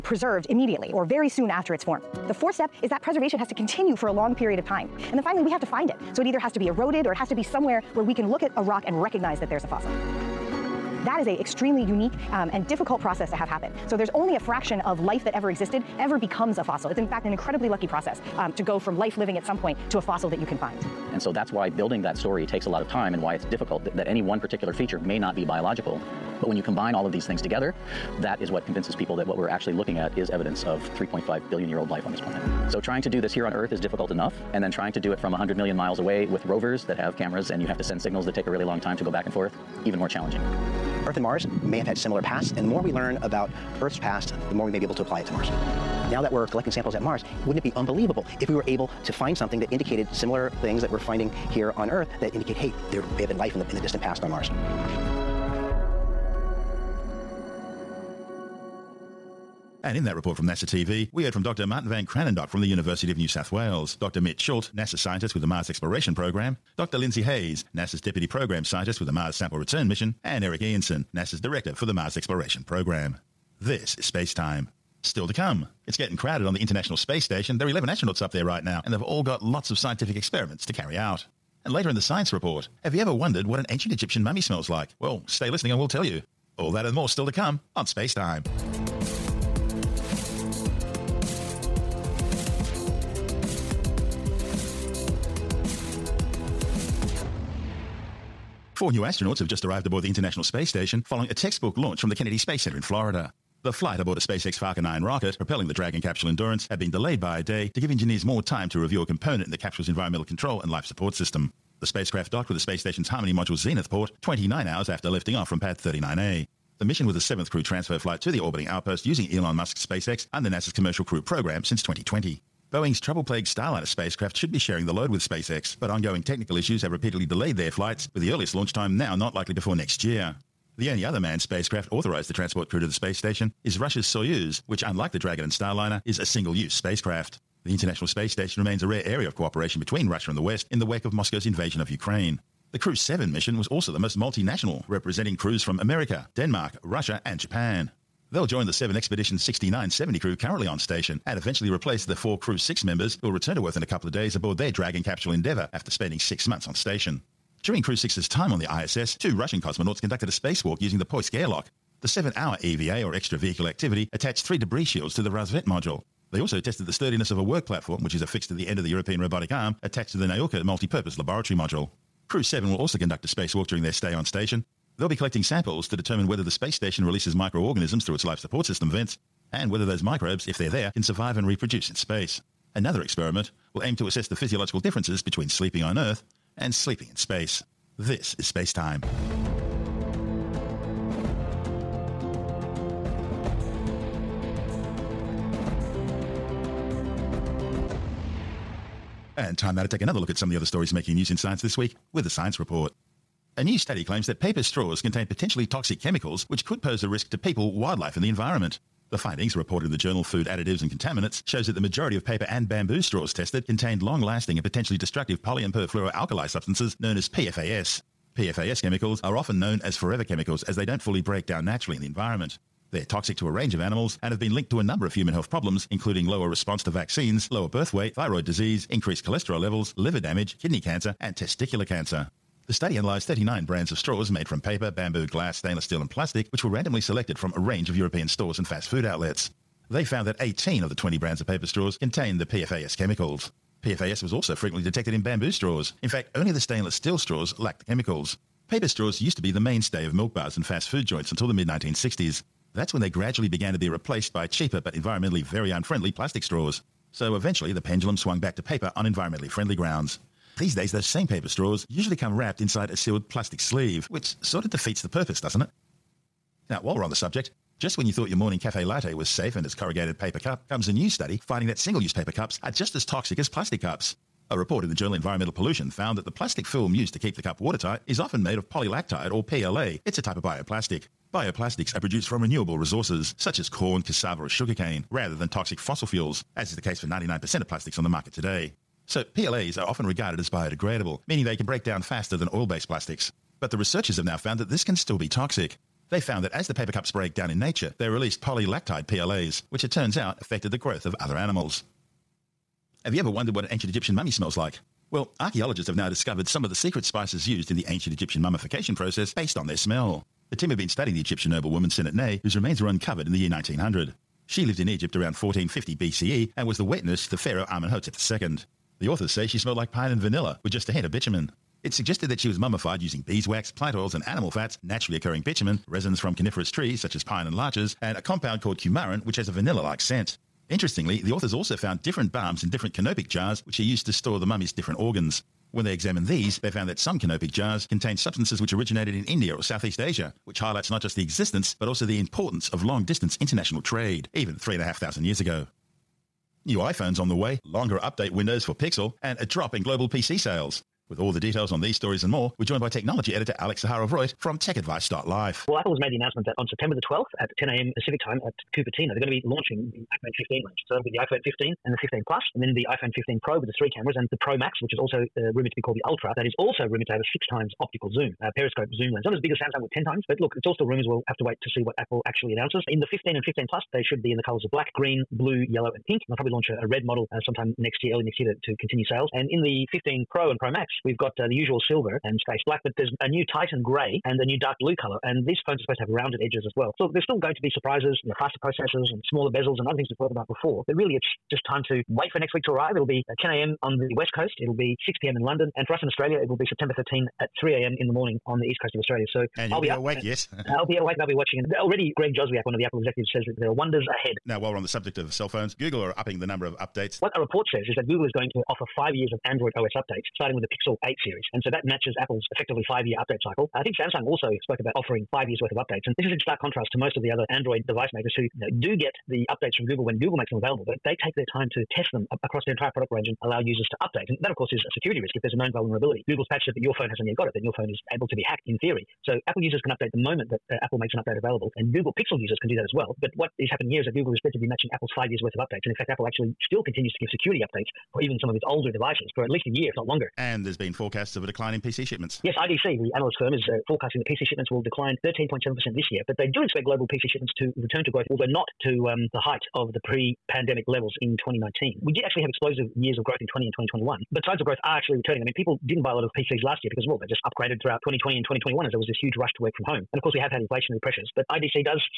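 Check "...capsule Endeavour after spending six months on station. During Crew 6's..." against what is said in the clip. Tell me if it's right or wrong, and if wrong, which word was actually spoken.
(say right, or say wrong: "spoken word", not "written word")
right.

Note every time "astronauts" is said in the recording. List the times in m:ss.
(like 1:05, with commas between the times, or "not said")
1:17, 1:39.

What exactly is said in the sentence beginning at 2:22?
The Crew 7 mission was also the most multinational, representing crews from America, Denmark, Russia, and Japan.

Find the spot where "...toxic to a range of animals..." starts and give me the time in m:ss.
3:43.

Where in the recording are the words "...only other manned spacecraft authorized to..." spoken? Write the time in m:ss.
2:10.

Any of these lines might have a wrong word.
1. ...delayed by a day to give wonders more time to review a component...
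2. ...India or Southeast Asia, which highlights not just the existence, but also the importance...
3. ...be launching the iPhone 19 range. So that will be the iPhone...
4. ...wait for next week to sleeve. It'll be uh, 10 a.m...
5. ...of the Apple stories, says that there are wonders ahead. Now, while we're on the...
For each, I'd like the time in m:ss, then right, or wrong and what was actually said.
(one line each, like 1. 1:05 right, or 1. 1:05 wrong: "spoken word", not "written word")
1. 1:46 wrong: "engineers", not "wonders"
2. 5:39 right
3. 5:59 wrong: "15", not "19"
4. 6:32 wrong: "arrive", not "sleeve"
5. 6:42 wrong: "executives", not "stories".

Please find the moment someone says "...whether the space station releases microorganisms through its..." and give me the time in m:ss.
2:56.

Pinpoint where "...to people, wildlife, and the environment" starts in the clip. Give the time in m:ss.
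3:27.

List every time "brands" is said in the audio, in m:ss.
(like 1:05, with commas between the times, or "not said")
3:53, 4:01.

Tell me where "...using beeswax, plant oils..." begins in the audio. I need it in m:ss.
5:23.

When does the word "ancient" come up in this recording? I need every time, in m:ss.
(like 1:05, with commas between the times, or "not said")
1:23, 5:03, 5:07.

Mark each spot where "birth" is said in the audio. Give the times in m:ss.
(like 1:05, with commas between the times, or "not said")
3:47.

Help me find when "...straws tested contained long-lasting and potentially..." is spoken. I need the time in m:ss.
3:33.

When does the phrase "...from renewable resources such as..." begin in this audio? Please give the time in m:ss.
4:42.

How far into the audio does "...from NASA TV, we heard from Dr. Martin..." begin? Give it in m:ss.
1:00.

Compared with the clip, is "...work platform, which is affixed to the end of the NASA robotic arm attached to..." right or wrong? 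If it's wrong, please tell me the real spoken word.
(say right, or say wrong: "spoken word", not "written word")
wrong: "European", not "NASA".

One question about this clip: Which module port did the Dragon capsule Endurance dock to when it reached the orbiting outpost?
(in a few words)
Harmony module Zenith port.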